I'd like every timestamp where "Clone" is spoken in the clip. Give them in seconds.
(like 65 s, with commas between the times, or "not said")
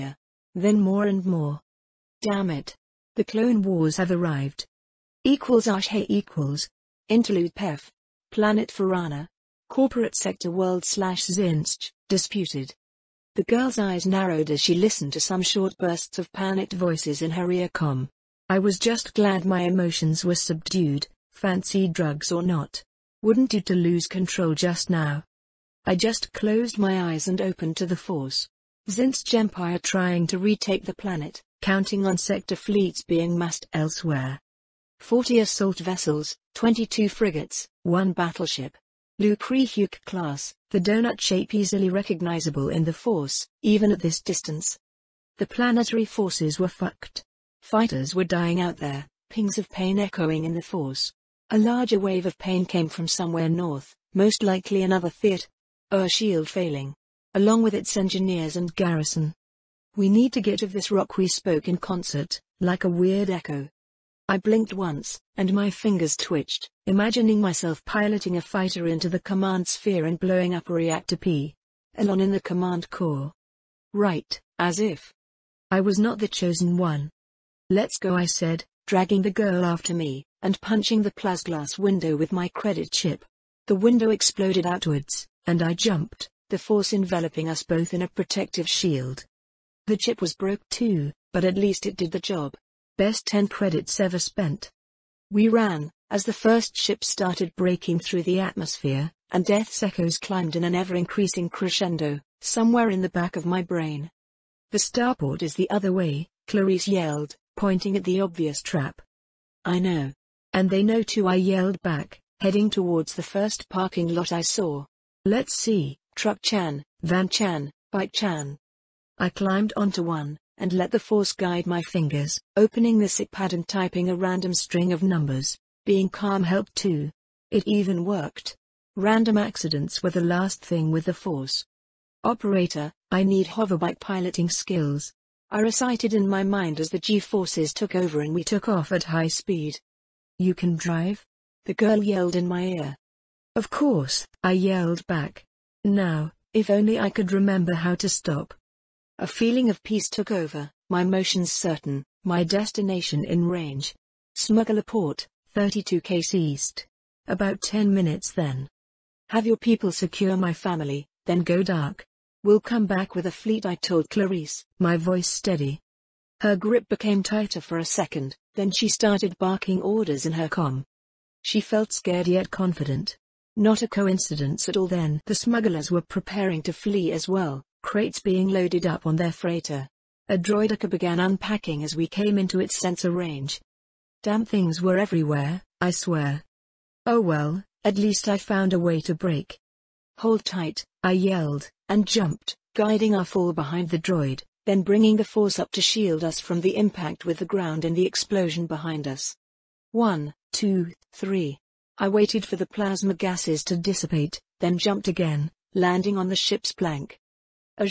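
3 s.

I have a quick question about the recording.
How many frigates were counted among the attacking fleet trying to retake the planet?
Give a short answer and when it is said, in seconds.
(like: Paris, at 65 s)
22, at 36 s.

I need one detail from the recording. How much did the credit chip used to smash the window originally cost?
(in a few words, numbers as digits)
10 credits.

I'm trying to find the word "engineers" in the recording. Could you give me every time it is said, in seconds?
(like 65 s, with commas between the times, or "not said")
57 s.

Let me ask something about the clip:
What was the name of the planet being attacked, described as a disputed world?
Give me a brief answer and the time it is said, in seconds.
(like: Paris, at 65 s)
Farana, at 8 s.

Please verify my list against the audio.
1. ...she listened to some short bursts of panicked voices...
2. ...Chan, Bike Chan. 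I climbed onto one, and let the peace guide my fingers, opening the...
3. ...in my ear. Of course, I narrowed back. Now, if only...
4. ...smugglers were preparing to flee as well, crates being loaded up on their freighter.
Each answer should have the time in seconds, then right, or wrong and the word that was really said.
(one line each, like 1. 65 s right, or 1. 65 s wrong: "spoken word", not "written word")
1. 14 s right
2. 117 s wrong: "force", not "peace"
3. 142 s wrong: "yelled", not "narrowed"
4. 175 s right.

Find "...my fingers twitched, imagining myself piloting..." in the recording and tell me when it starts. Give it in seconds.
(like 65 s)
65 s.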